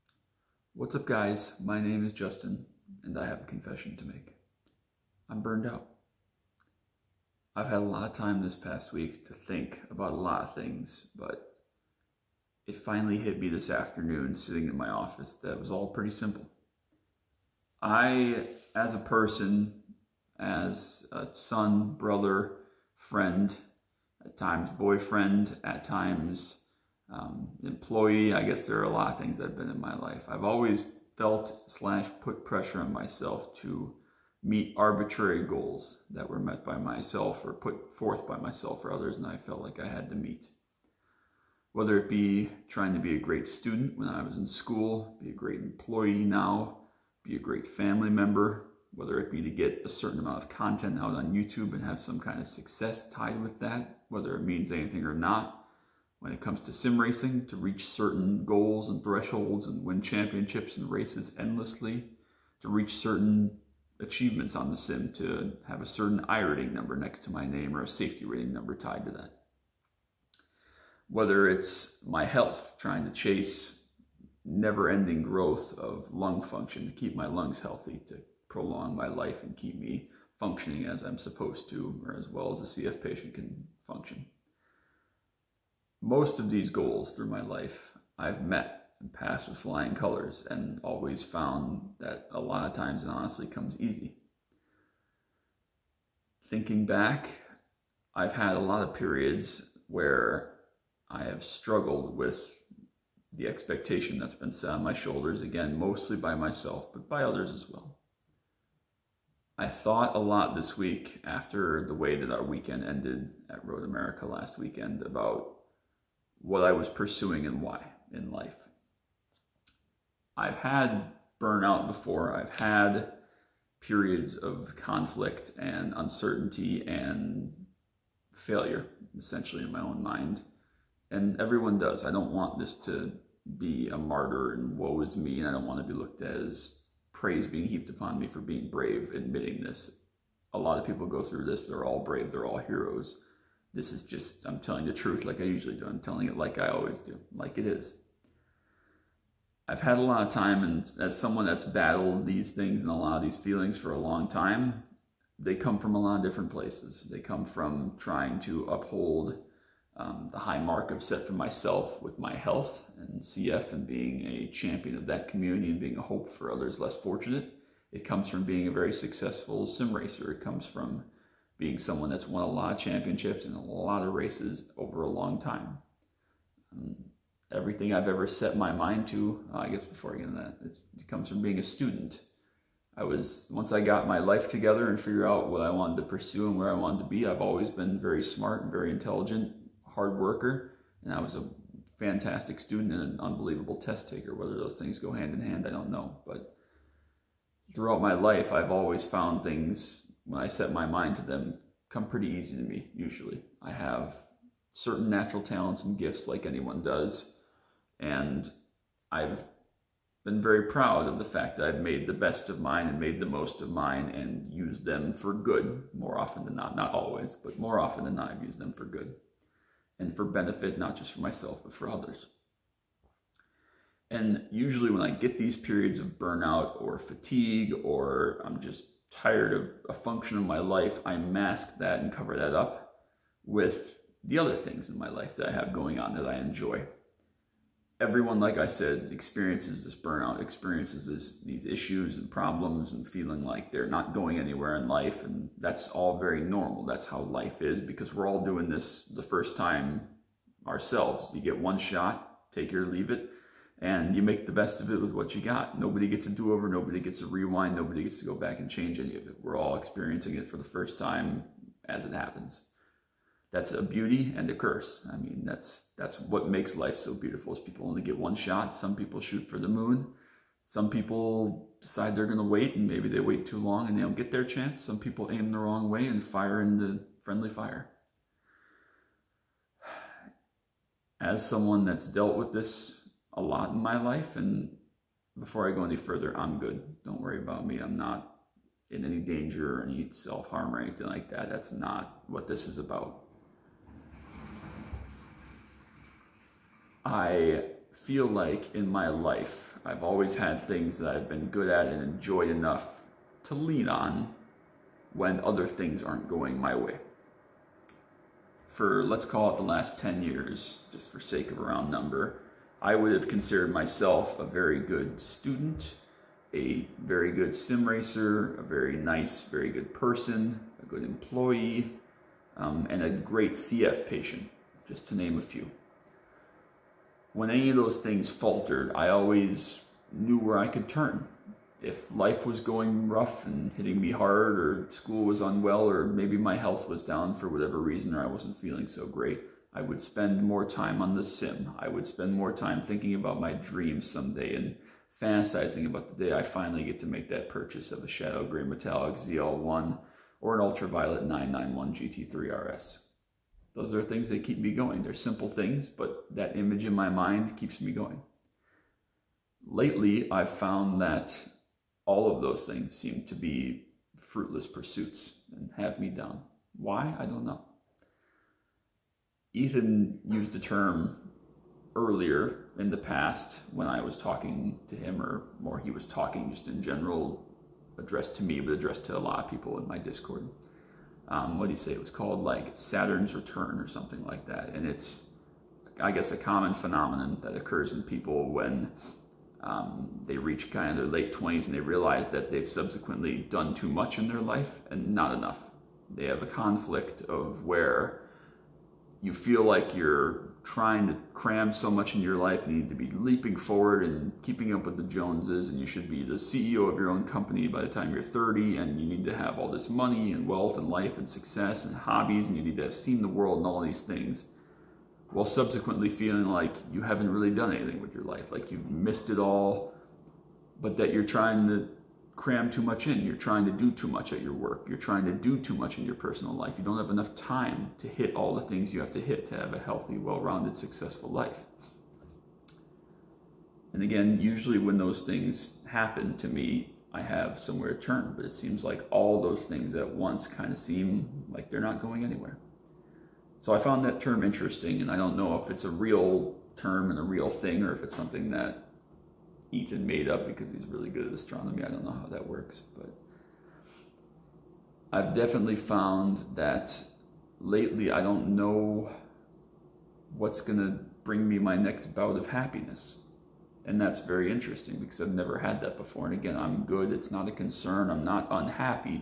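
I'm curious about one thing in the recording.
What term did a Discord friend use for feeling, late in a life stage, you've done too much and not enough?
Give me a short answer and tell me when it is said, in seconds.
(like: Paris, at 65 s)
Saturn's return, at 382 s.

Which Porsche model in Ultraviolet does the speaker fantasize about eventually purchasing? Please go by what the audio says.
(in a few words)
991 GT3 RS.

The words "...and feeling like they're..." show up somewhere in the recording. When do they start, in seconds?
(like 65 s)
242 s.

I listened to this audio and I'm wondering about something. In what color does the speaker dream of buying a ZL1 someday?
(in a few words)
Shadow Gray Metallic.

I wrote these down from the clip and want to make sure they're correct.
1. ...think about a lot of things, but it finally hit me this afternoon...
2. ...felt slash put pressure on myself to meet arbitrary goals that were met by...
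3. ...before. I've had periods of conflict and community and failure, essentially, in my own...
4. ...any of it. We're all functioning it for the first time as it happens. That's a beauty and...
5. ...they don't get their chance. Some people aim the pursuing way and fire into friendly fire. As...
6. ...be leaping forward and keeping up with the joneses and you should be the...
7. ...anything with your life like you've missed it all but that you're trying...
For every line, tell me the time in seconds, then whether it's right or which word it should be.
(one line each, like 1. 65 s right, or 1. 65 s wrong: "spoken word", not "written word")
1. 9 s right
2. 31 s right
3. 121 s wrong: "uncertainty", not "community"
4. 258 s wrong: "experiencing", not "functioning"
5. 273 s wrong: "wrong", not "pursuing"
6. 402 s right
7. 417 s right.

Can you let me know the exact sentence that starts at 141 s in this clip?
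They're all brave, they're all heroes.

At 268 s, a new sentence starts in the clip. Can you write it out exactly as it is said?
Some people shoot for the moon.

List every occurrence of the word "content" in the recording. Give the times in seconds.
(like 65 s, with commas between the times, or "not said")
50 s.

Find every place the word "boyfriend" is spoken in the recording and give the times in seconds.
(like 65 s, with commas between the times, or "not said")
24 s.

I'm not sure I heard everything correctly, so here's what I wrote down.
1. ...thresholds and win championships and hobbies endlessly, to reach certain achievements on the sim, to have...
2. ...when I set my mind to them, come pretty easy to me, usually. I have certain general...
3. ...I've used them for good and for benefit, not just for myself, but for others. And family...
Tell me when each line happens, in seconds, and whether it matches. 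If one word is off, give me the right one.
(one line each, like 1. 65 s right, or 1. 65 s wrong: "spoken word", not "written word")
1. 59 s wrong: "races", not "hobbies"
2. 200 s wrong: "natural", not "general"
3. 218 s wrong: "usually", not "family".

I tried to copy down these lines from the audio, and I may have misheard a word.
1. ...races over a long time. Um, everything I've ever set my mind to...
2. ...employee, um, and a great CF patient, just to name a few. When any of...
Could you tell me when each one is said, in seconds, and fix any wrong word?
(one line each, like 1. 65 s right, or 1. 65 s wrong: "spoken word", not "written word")
1. 174 s right
2. 321 s right.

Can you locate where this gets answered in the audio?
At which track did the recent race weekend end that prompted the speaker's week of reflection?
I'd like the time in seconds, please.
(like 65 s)
113 s.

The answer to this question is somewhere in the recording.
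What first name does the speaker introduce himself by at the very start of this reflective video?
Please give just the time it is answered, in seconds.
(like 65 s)
2 s.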